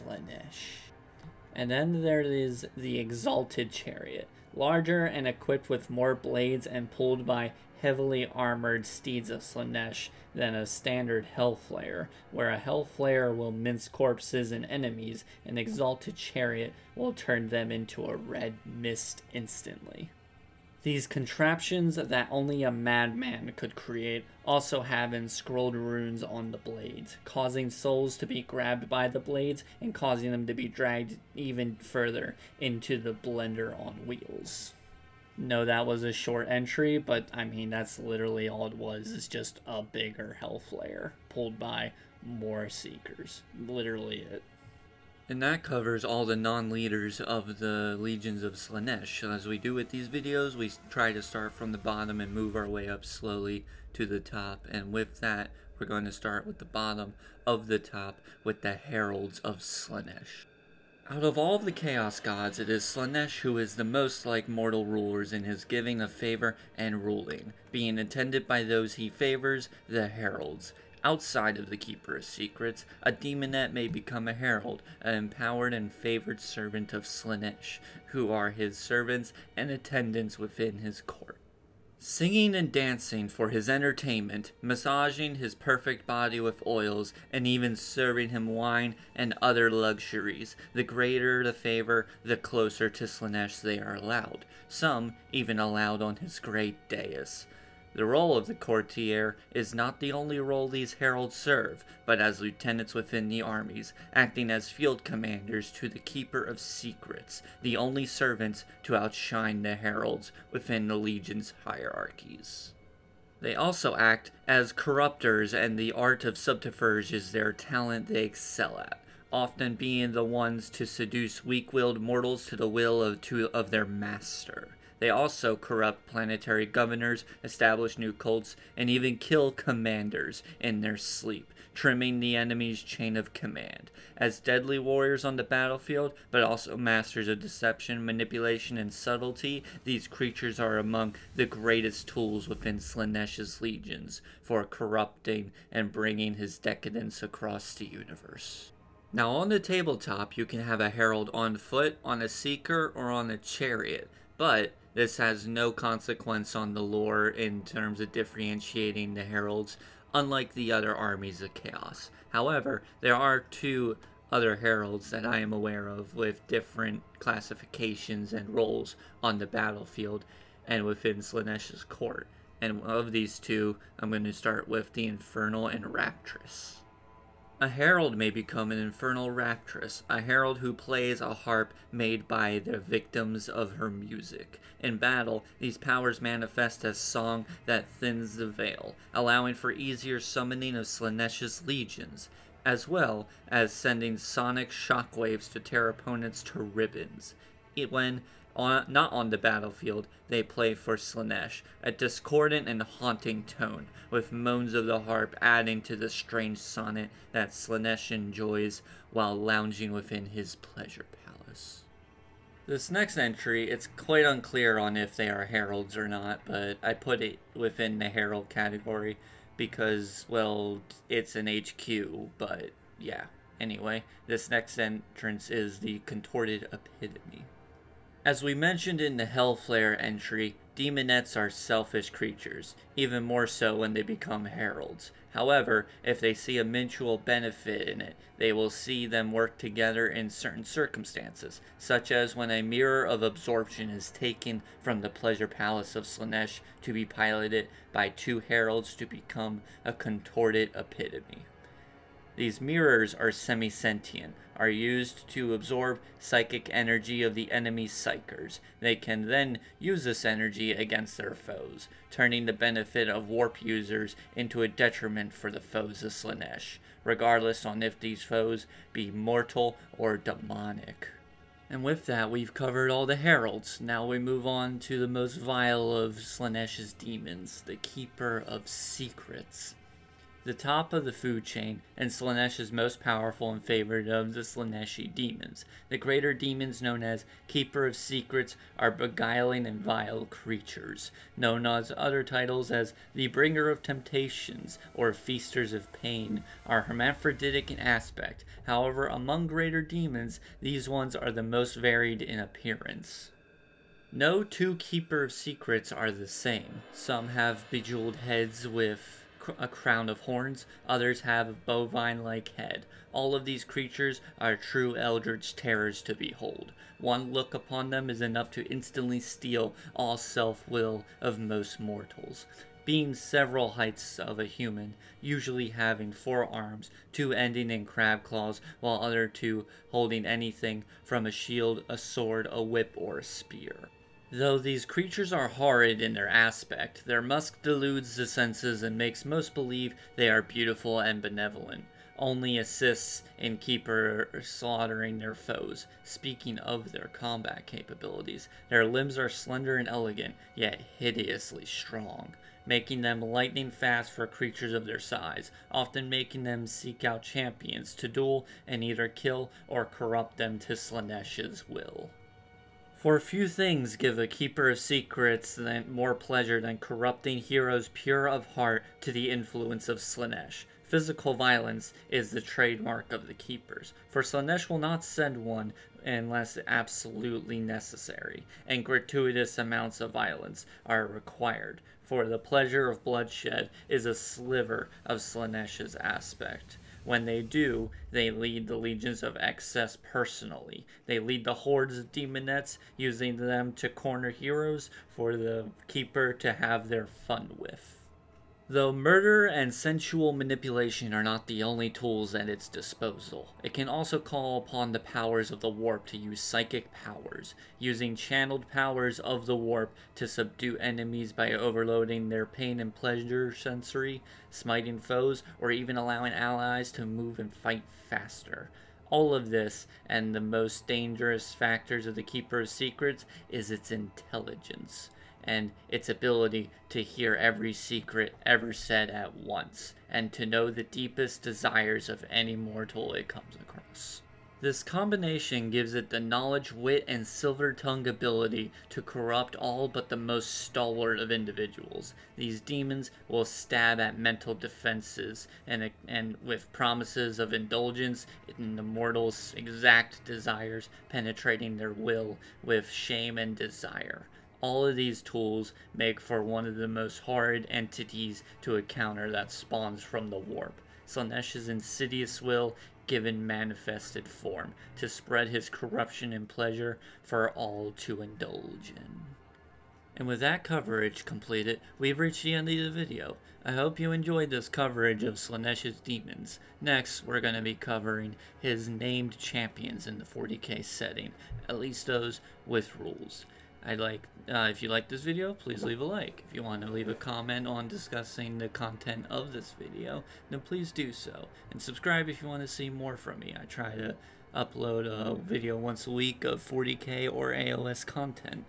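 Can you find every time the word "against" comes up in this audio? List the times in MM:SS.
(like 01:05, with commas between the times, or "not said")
04:20.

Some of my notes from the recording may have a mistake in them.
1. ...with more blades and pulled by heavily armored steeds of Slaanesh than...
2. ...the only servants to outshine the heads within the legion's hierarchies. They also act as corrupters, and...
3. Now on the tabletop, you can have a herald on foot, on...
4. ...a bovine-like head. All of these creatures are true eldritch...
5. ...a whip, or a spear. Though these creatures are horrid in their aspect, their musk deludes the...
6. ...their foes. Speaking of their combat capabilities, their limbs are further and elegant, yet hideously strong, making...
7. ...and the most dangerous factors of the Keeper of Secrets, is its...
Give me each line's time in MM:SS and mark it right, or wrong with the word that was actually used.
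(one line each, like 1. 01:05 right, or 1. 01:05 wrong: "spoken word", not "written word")
1. 00:05 right
2. 01:47 wrong: "heralds", not "heads"
3. 02:29 right
4. 05:11 right
5. 05:32 right
6. 05:45 wrong: "slender", not "further"
7. 07:00 right.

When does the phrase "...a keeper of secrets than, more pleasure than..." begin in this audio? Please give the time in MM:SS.
06:04.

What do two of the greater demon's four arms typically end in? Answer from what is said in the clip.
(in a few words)
Crab claws.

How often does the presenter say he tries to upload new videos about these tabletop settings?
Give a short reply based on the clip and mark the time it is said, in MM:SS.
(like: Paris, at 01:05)
Once a week, at 08:15.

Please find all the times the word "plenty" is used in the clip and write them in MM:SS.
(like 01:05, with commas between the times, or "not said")
not said.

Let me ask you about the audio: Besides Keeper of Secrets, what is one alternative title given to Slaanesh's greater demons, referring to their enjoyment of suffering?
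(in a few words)
Feasters of Pain.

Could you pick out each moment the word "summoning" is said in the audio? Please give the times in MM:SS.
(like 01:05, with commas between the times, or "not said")
03:10.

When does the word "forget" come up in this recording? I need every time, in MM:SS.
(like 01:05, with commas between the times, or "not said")
not said.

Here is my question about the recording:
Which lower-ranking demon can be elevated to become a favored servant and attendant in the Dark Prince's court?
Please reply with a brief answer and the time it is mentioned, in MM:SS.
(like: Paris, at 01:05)
Demonette, at 01:13.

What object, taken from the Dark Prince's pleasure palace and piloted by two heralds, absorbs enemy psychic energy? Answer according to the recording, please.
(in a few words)
Mirror of absorption.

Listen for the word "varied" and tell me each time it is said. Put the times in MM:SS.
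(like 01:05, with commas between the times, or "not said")
05:01.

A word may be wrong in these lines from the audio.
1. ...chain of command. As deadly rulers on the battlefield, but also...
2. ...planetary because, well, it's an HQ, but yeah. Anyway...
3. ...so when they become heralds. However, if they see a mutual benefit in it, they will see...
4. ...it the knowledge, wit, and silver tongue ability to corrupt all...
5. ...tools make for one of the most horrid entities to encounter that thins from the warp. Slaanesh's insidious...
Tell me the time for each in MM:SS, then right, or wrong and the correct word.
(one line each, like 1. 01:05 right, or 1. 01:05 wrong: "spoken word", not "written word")
1. 02:12 wrong: "warriors", not "rulers"
2. 03:38 wrong: "category", not "planetary"
3. 03:53 right
4. 07:15 right
5. 07:35 wrong: "spawns", not "thins".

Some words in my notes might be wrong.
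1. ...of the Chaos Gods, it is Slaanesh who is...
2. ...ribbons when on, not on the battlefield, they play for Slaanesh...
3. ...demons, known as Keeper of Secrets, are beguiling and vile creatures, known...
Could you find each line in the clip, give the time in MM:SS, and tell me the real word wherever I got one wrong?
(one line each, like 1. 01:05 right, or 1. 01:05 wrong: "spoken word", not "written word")
1. 01:01 right
2. 03:16 right
3. 04:46 right.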